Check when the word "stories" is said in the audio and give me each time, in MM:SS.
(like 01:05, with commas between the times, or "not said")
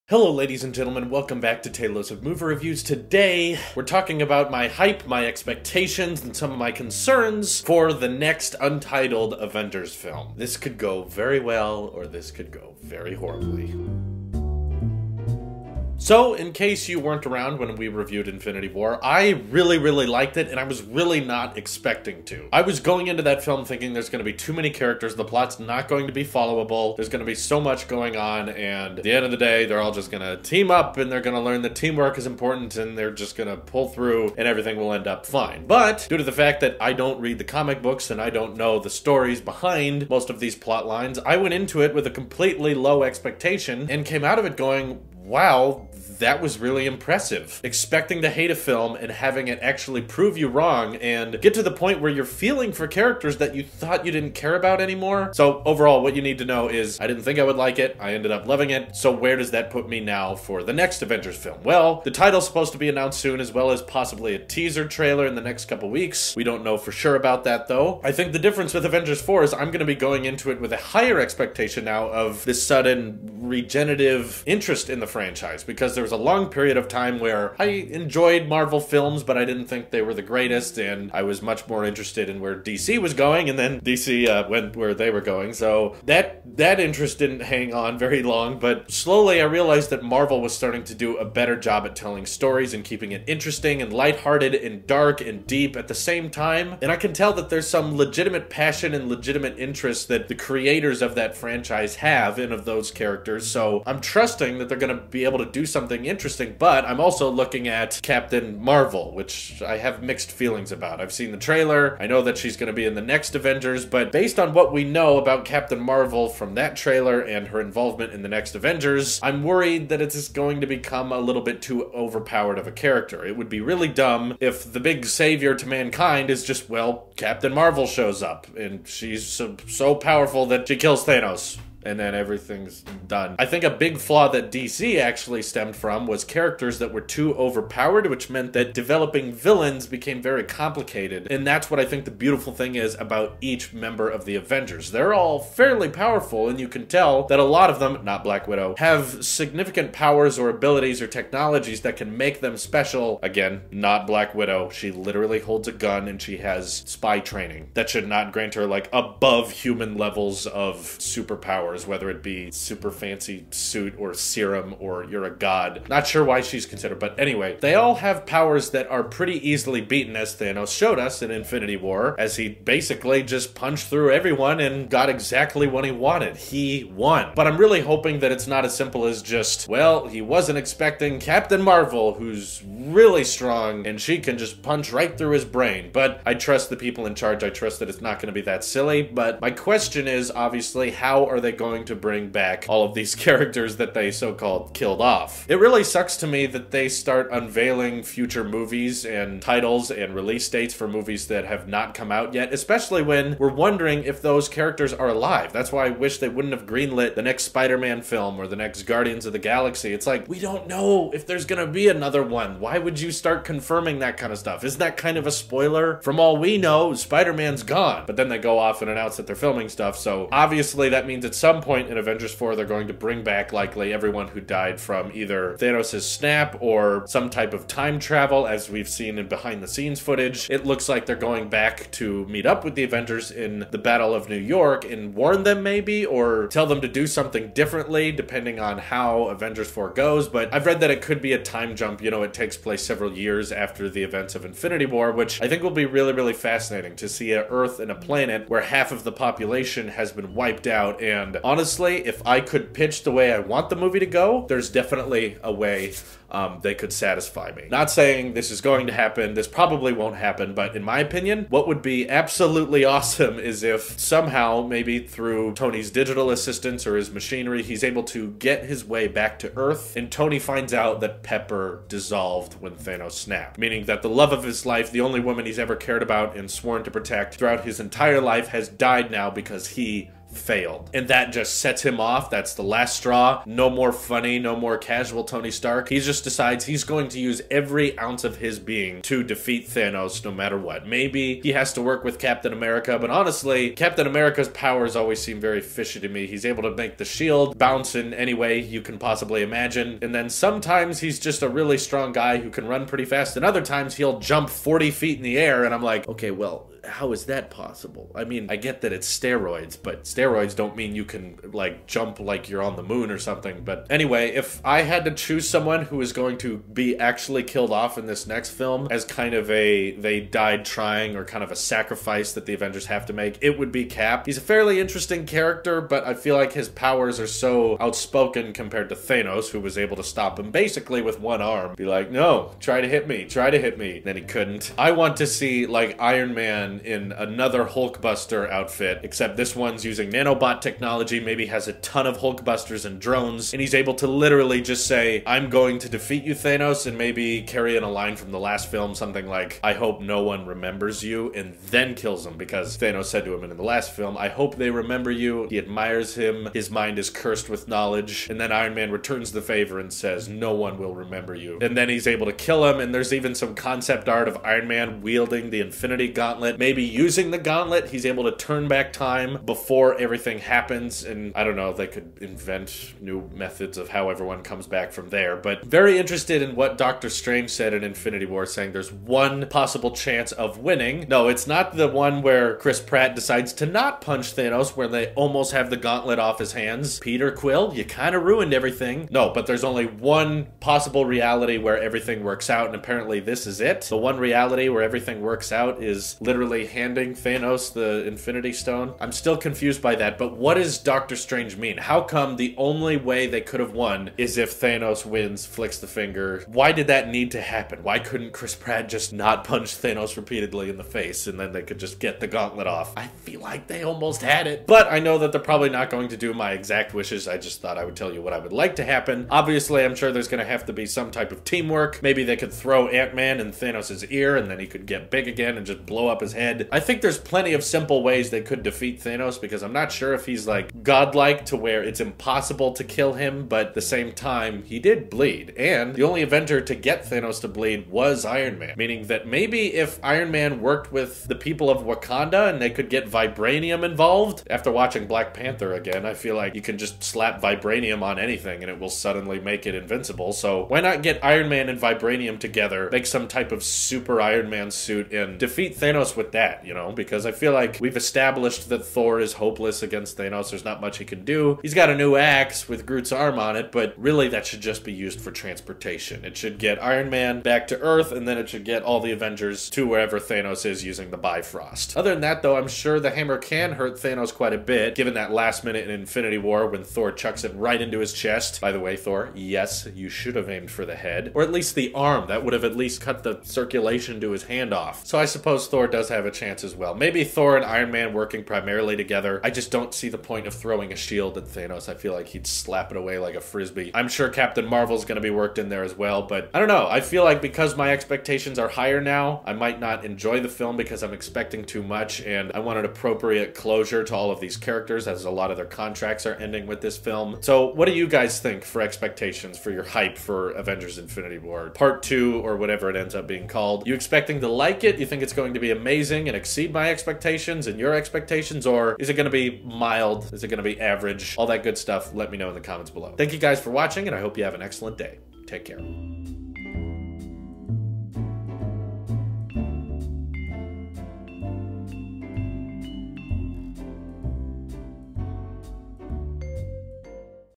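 00:38, 01:32.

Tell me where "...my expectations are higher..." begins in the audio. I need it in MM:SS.
08:17.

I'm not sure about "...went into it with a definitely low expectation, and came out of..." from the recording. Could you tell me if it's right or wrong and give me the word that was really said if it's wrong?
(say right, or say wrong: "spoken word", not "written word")
wrong: "completely", not "definitely".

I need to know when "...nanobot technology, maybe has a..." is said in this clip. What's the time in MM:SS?
05:40.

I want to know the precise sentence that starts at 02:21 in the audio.
And that's what I think the beautiful thing is about each member of the Avengers.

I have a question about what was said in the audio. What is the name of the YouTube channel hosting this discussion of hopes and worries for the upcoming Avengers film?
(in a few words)
Tailosive Movie Reviews.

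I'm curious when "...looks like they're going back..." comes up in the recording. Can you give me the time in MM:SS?
03:50.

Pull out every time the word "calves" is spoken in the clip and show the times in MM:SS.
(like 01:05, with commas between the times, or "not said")
not said.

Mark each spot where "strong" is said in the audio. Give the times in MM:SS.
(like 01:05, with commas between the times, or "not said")
03:03, 05:01.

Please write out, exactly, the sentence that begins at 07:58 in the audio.
By the way, Thor, yes, you should have aimed for the head, or at least the arm.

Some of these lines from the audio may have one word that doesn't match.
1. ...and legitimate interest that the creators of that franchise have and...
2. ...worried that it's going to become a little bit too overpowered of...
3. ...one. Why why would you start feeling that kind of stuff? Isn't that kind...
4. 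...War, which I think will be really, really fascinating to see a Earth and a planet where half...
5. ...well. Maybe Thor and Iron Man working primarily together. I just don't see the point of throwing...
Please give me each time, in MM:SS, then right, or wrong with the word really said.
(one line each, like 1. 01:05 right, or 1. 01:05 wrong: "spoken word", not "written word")
1. 01:38 right
2. 01:59 right
3. 03:32 wrong: "confirming", not "feeling"
4. 04:04 right
5. 08:06 right.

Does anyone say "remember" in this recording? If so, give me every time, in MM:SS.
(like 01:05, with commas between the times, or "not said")
05:50, 05:54, 06:00.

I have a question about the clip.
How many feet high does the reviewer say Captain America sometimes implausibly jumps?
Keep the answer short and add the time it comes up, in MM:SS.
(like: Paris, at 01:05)
40, at 05:04.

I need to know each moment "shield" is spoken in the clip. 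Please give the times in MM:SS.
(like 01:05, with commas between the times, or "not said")
04:57, 08:10.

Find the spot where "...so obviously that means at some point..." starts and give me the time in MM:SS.
03:39.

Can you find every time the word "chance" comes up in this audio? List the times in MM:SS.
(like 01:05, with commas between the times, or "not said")
06:19, 08:06.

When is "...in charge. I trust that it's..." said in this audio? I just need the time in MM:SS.
03:07.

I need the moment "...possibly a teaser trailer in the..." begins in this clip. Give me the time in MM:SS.
01:03.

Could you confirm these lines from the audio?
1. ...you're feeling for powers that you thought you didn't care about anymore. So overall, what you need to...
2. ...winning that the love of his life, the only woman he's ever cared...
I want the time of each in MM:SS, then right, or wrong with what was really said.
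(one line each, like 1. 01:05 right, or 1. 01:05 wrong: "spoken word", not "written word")
1. 00:52 wrong: "characters", not "powers"
2. 04:33 wrong: "meaning", not "winning".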